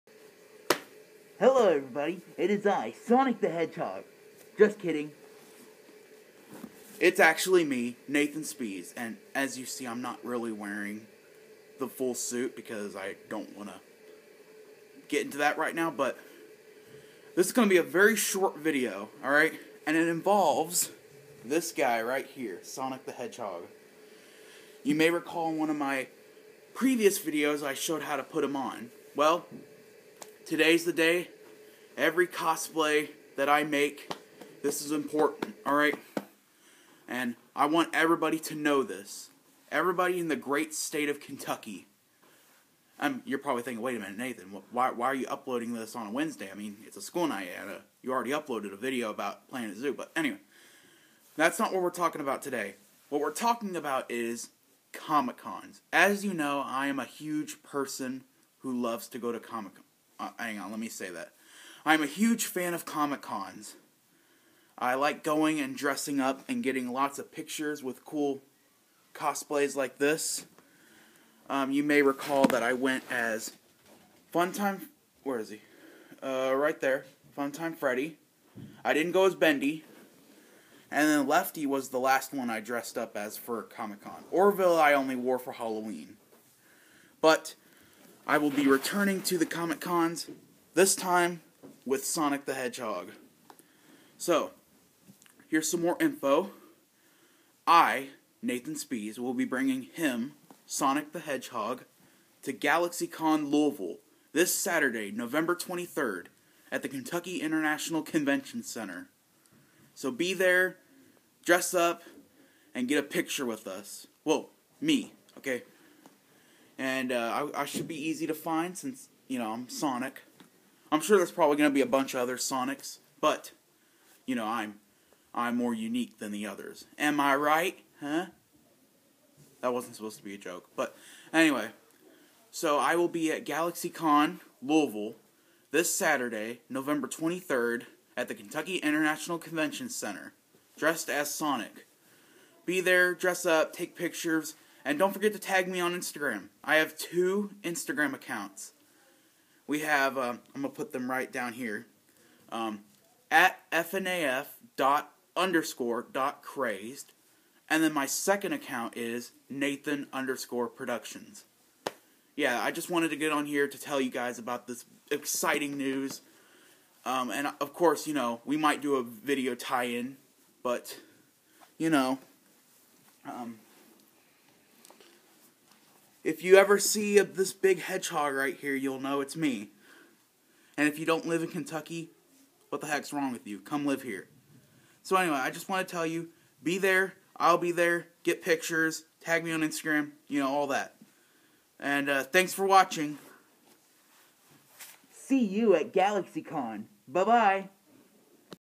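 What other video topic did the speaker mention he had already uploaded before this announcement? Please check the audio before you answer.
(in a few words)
Planet Zoo.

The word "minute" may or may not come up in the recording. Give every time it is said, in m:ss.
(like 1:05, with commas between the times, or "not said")
0:44.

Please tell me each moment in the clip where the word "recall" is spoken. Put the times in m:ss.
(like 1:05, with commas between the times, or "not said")
0:25, 1:12.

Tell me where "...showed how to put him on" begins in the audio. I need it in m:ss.
0:27.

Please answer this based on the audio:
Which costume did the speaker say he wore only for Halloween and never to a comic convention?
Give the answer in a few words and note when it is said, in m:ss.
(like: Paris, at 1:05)
Orville, at 1:24.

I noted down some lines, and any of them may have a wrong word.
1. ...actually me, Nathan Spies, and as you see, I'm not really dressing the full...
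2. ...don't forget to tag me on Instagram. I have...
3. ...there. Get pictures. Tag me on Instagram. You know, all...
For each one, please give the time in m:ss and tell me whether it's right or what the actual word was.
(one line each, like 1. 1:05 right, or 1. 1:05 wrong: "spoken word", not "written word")
1. 0:07 wrong: "wearing", not "dressing"
2. 2:24 right
3. 3:07 right.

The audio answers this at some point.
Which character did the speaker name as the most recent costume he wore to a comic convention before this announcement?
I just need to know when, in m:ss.
1:21.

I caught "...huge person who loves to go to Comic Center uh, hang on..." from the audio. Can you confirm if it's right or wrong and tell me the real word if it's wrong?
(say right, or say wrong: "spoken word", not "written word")
wrong: "Con", not "Center".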